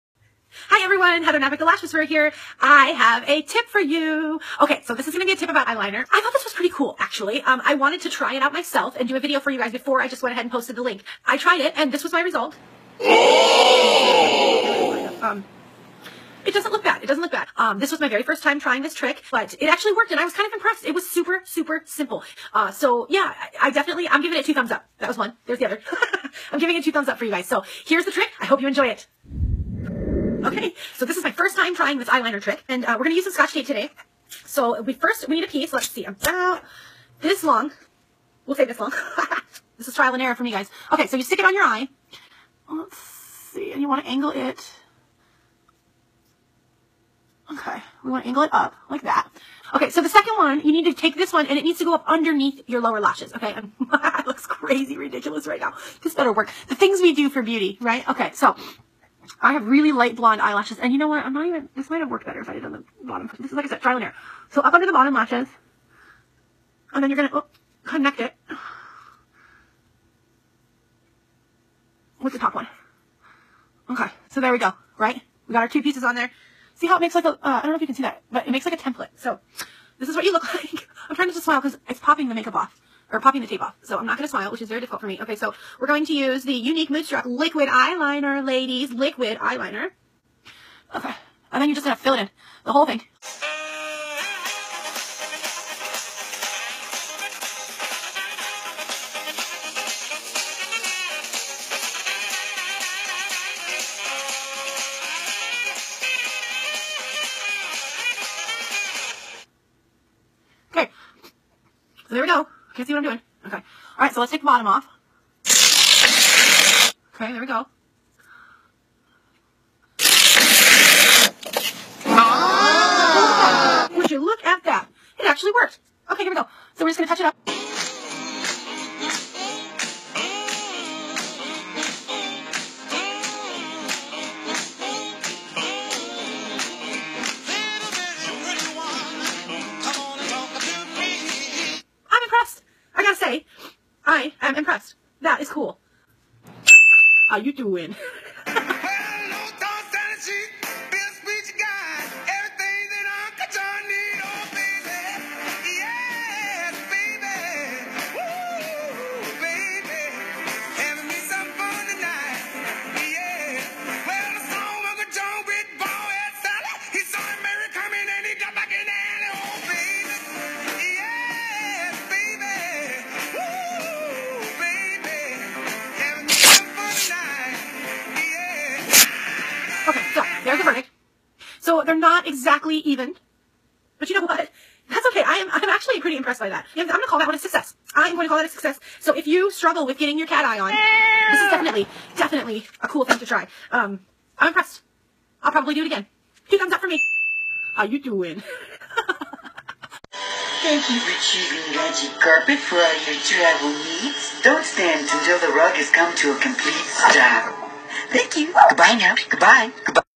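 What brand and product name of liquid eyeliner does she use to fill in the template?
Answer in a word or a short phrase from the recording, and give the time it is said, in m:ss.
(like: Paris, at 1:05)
Younique Moodstruck, at 1:26.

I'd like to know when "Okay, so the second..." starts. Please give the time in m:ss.
0:49.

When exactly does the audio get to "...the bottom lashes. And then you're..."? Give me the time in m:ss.
1:04.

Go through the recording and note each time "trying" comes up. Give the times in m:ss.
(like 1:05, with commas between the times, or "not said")
0:18, 0:31, 1:21.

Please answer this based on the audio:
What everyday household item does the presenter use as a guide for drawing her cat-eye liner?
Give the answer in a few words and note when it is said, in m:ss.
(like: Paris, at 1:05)
Scotch tape, at 0:33.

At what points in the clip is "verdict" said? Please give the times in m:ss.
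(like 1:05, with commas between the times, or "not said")
3:00.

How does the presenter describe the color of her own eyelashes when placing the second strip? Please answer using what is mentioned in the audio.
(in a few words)
Light blonde.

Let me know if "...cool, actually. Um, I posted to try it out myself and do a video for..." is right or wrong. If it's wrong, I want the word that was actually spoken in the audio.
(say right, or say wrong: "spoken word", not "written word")
wrong: "wanted", not "posted".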